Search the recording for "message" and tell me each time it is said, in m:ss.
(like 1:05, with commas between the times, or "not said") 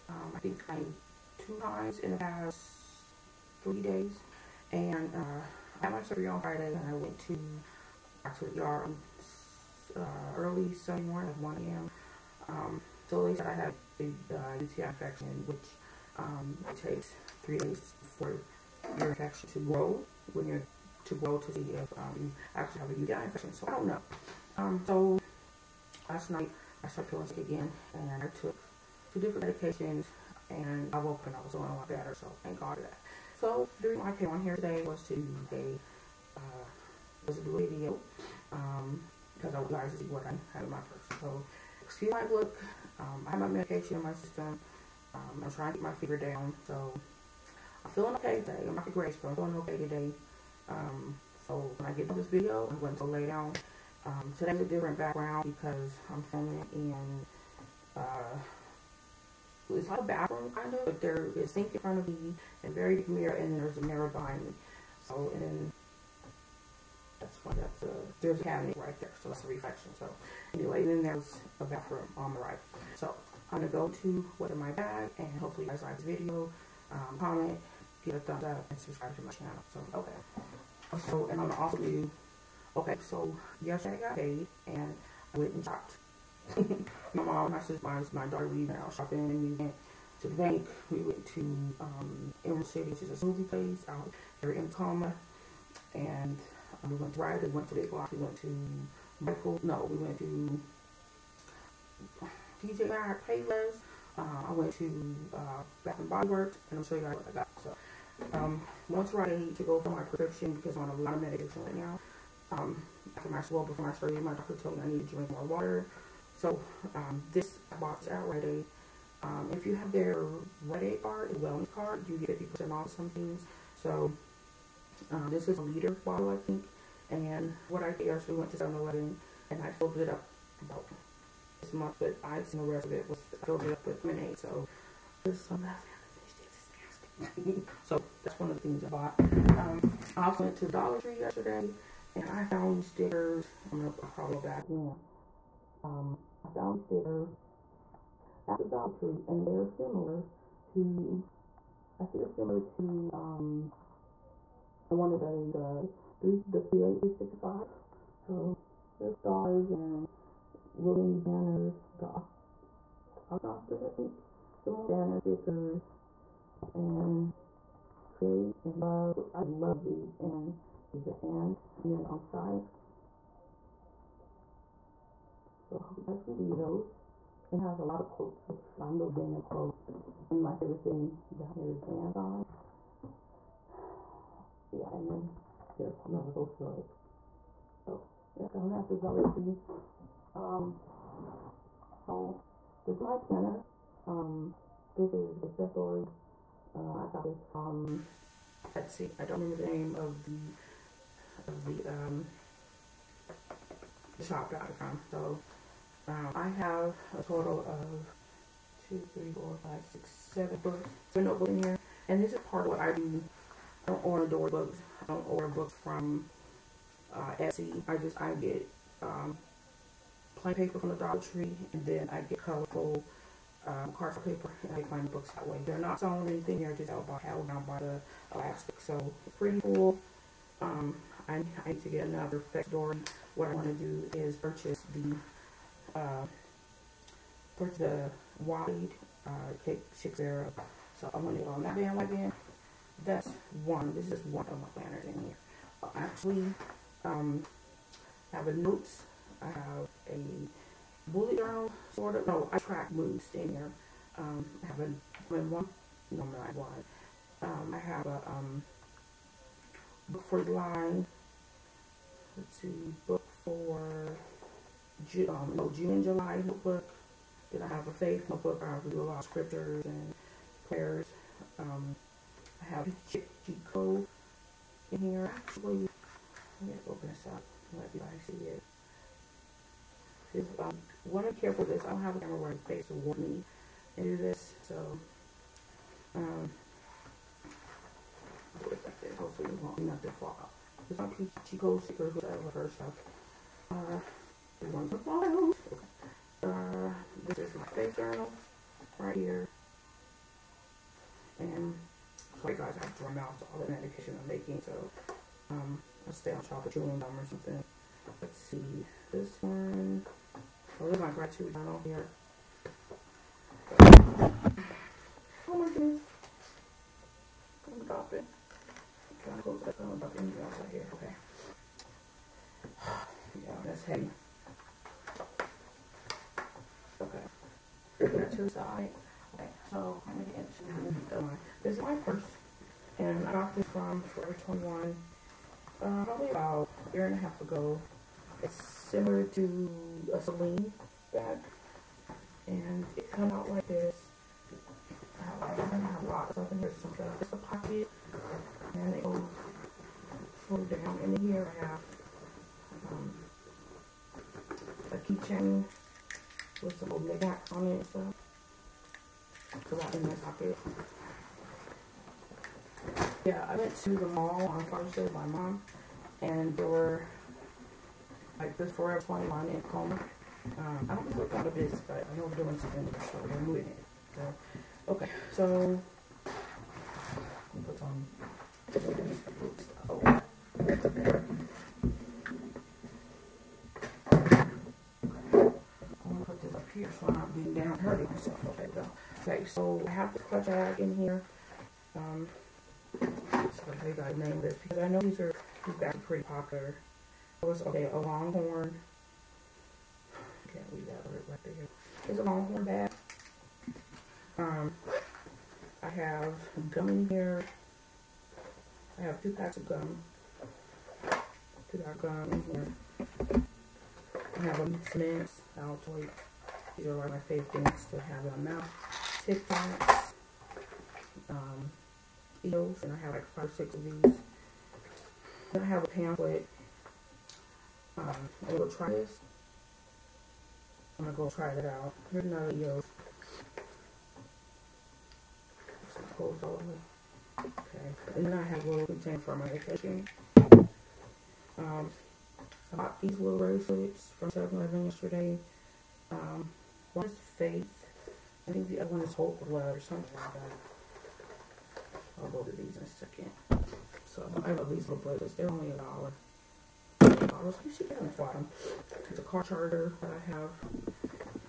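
not said.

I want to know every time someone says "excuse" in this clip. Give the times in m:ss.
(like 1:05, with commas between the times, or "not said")
0:41.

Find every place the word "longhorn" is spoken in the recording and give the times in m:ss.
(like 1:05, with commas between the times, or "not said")
6:37, 6:42.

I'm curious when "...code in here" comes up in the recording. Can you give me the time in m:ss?
4:33.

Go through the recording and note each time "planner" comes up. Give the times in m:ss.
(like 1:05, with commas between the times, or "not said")
3:13, 4:04.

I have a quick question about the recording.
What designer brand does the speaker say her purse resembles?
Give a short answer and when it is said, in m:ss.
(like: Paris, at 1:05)
Celine, at 5:40.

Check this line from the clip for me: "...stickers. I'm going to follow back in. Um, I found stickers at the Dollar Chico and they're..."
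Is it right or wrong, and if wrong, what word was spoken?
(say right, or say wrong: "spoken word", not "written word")
wrong: "Tree", not "Chico".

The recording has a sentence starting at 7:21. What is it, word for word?
Um, I bought these little bracelets from 7-Eleven yesterday.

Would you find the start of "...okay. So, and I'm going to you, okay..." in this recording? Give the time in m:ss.
1:19.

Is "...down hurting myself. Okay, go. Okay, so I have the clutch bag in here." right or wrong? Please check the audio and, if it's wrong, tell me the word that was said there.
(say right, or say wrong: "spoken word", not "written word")
right.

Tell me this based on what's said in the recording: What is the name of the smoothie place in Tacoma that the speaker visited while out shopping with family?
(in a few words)
Emerald City.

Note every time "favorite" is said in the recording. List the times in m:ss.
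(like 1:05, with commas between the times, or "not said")
3:00, 6:57.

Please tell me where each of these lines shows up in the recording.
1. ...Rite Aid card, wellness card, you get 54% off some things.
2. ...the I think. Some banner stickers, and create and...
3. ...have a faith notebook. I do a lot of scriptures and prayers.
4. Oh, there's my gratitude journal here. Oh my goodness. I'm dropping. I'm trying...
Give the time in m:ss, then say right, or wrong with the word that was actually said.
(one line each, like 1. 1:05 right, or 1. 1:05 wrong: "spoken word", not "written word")
1. 2:00 wrong: "50", not "54"
2. 2:43 right
3. 4:27 right
4. 5:10 right.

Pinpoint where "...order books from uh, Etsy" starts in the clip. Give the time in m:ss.
3:35.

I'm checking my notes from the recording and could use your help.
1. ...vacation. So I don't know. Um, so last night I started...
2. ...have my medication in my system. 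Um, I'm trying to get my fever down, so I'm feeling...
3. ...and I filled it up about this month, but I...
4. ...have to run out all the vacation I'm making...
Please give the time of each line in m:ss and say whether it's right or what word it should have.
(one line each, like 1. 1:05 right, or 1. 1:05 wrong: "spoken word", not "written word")
1. 0:23 wrong: "infection", not "vacation"
2. 0:43 right
3. 2:09 right
4. 5:02 wrong: "medication", not "vacation".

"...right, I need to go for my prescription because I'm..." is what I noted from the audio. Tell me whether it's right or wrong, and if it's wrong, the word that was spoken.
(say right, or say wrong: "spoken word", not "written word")
right.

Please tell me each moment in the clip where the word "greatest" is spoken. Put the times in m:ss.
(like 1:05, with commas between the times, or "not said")
0:48.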